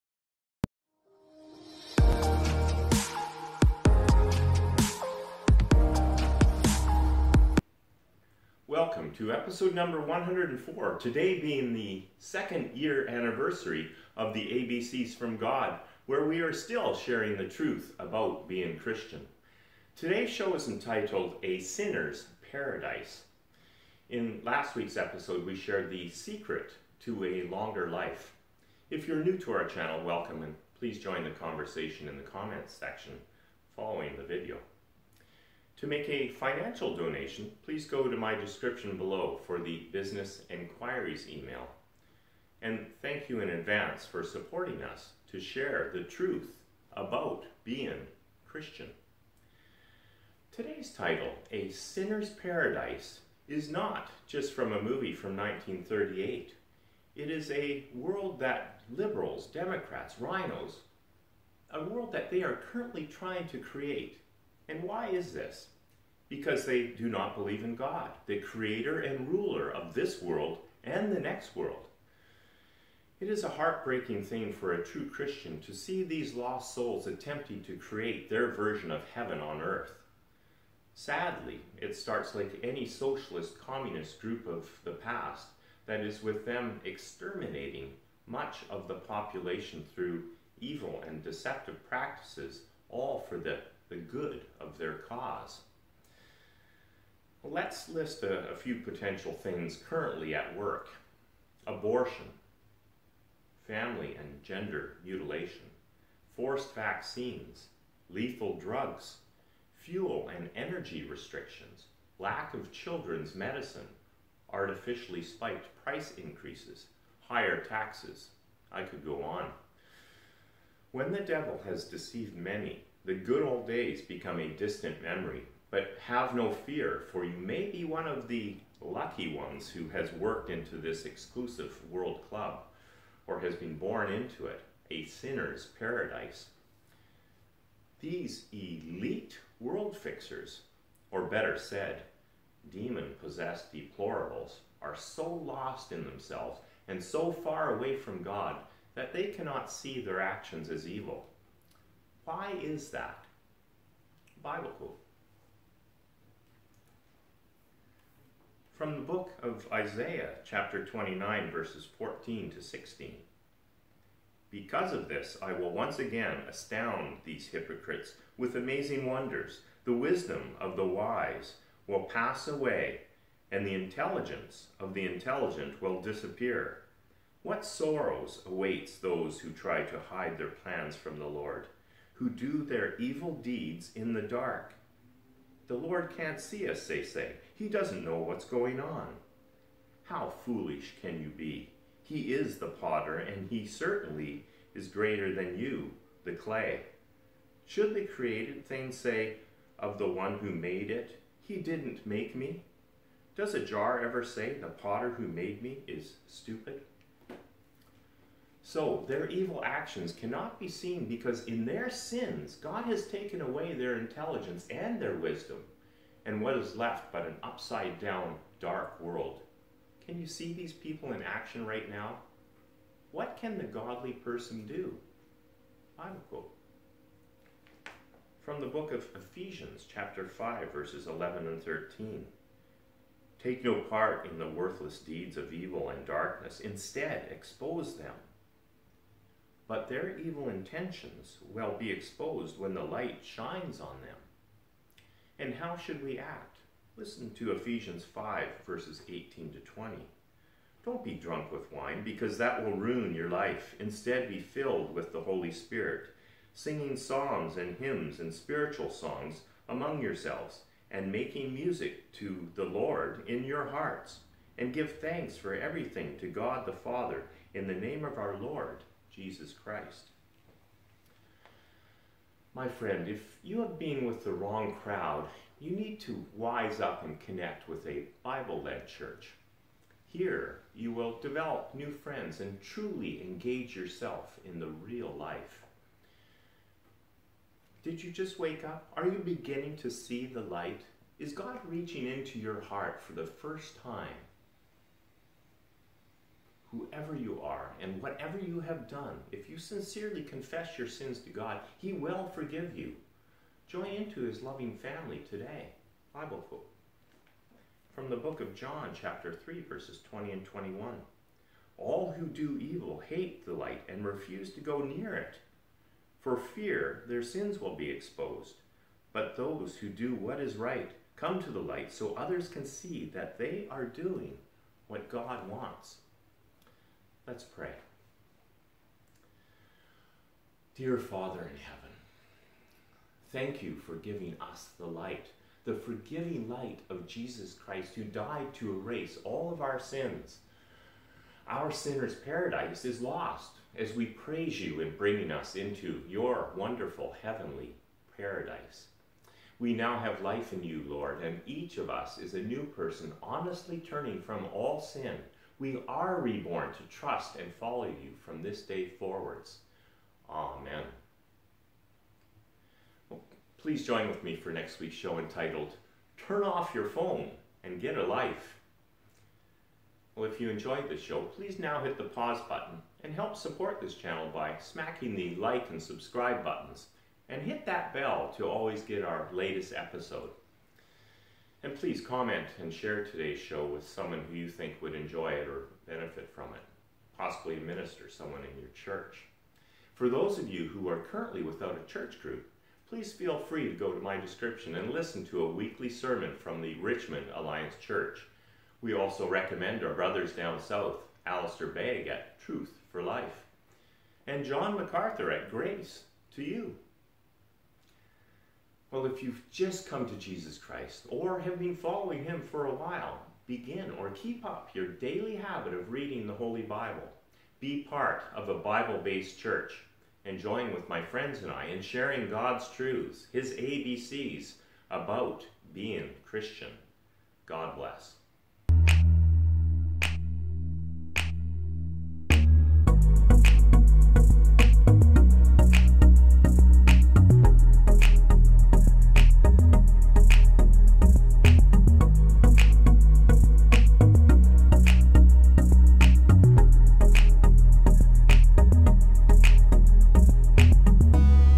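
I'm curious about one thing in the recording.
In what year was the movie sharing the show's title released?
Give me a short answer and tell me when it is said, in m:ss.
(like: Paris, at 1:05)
1938, at 0:55.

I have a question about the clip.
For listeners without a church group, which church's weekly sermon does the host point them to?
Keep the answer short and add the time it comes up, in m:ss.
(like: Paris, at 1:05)
Richmond Alliance Church, at 6:36.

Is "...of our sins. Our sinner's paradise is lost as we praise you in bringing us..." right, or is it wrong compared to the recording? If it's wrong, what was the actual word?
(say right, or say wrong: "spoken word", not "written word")
right.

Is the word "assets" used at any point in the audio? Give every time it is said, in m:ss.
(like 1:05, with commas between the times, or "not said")
not said.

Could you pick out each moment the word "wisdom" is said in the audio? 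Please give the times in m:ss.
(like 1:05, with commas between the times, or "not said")
2:49, 3:35.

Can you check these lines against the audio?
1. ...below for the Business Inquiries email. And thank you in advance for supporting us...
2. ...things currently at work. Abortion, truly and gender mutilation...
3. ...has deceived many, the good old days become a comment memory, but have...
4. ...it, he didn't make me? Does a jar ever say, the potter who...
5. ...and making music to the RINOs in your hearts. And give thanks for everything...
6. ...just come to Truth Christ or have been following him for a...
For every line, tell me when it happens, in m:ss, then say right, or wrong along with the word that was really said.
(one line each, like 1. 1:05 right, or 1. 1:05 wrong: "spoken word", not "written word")
1. 0:38 right
2. 1:39 wrong: "family", not "truly"
3. 2:01 wrong: "distant", not "comment"
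4. 3:20 right
5. 4:20 wrong: "Lord", not "RINOs"
6. 6:49 wrong: "Jesus", not "Truth".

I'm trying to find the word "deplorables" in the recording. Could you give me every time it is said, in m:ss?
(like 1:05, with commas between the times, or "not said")
2:23.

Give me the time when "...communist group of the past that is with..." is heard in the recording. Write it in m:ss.
1:23.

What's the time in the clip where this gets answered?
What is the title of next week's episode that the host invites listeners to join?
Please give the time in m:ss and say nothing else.
6:06.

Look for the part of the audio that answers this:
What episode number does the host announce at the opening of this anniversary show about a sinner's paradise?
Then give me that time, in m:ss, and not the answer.
0:10.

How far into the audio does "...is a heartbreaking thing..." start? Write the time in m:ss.
1:13.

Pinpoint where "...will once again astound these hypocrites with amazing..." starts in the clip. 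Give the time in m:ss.
2:45.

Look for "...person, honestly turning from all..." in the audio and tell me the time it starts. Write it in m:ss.
5:52.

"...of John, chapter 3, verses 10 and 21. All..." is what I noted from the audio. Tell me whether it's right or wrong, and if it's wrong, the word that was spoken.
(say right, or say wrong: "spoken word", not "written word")
wrong: "20", not "10".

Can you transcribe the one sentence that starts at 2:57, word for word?
What sorrows awaits those who try to hide their plans from the Lord?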